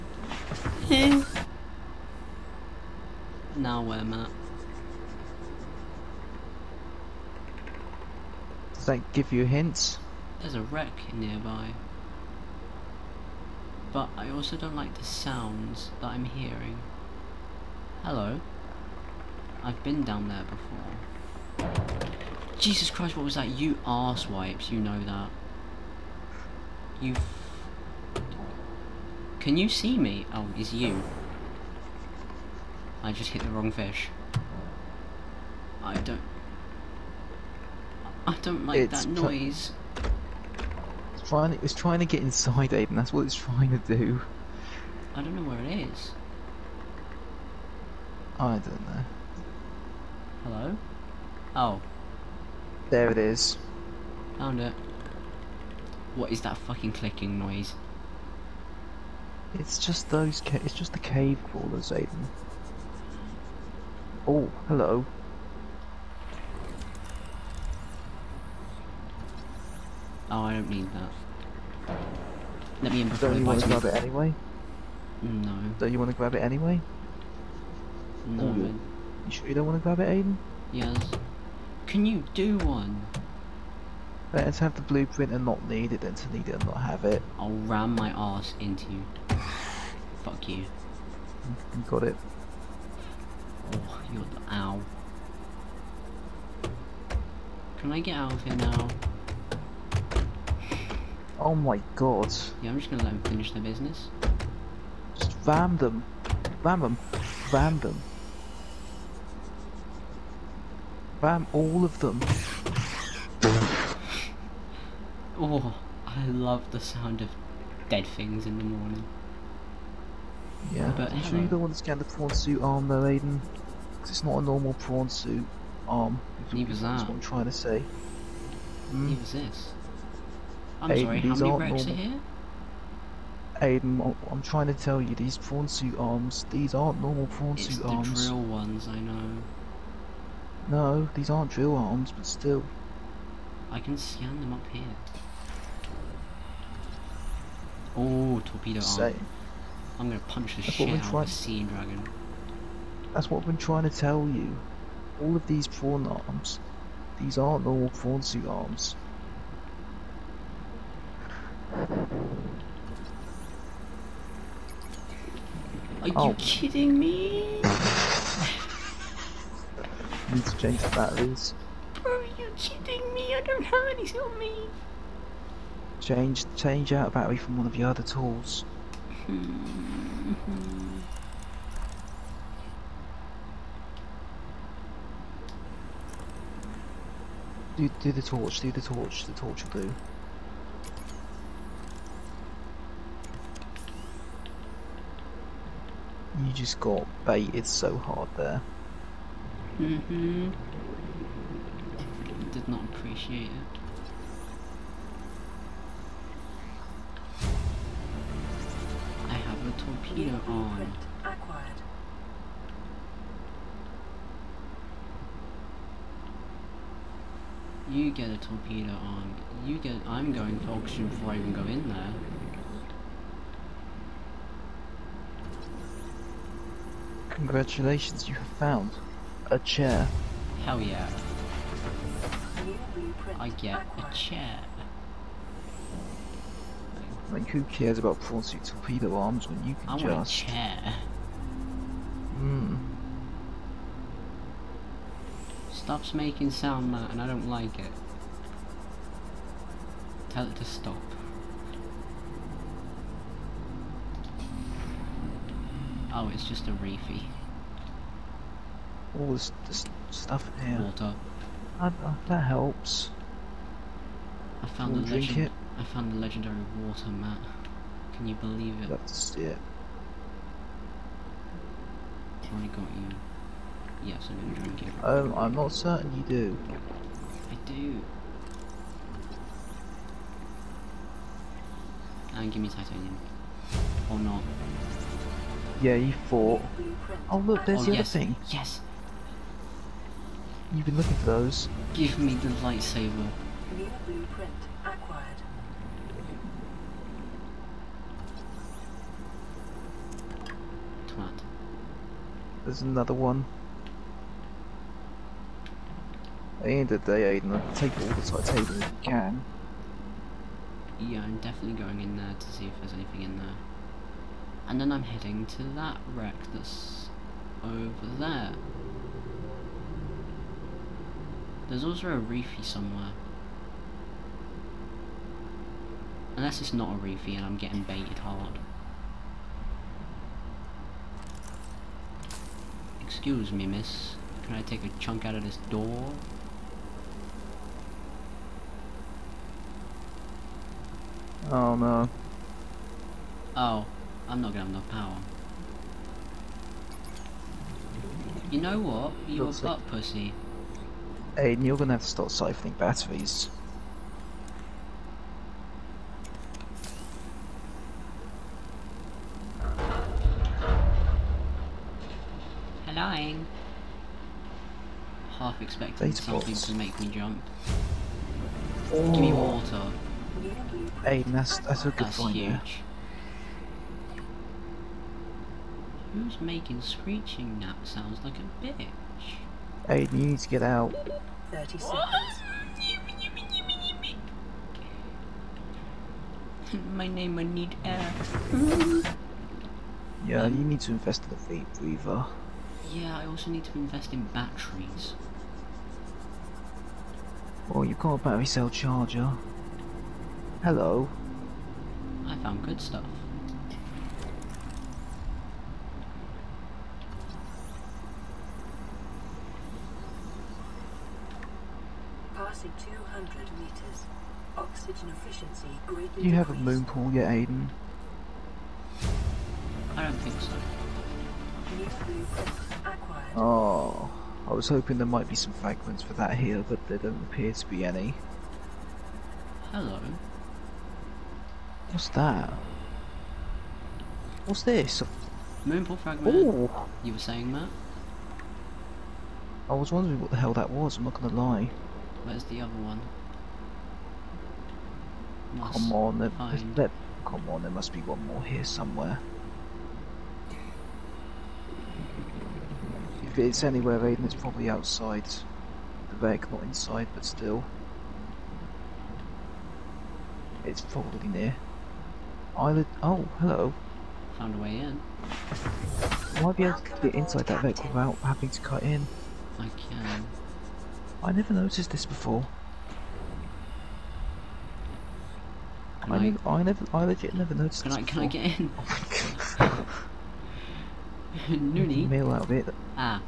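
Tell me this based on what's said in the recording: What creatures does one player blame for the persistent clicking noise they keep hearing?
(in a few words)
cave crawlers.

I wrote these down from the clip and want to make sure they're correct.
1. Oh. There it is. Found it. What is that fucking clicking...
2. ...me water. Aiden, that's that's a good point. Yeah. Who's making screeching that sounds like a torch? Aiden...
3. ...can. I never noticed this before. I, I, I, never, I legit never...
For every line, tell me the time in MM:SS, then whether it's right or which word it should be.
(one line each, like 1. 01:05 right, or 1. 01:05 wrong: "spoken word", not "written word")
1. 00:51 right
2. 06:09 wrong: "bitch", not "torch"
3. 07:49 right.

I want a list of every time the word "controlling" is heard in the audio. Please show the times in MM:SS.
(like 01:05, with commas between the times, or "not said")
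not said.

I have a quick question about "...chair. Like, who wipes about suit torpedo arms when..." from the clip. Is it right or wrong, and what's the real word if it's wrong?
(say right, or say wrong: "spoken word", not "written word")
wrong: "cares", not "wipes".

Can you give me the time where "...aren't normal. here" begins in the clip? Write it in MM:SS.
02:11.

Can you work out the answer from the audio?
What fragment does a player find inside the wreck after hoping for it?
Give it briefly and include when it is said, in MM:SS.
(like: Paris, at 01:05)
Moonpool fragment, at 07:15.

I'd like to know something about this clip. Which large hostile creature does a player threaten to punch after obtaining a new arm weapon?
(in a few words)
sea dragon.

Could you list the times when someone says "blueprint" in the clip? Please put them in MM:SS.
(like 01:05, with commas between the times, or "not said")
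01:24, 04:54.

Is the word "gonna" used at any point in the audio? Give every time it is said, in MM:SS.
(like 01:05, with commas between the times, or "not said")
01:42, 02:30, 04:34, 05:44, 05:51, 07:21.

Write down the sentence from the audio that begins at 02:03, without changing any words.
Because it's not a normal prawn suit arm.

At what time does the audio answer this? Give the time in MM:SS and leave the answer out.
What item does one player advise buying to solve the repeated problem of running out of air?
06:31.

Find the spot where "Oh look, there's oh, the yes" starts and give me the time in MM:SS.
04:47.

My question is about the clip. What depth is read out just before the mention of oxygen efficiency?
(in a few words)
200 meters.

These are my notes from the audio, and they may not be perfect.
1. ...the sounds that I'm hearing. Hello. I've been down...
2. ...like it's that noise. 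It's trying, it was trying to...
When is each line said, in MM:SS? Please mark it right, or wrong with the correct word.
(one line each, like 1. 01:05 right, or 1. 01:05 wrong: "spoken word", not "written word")
1. 00:14 right
2. 00:38 right.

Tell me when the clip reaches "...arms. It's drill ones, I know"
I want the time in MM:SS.
02:17.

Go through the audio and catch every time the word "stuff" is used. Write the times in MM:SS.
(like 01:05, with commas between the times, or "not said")
04:20, 06:42.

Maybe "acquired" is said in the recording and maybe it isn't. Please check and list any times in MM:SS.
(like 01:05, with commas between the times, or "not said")
03:31, 04:54.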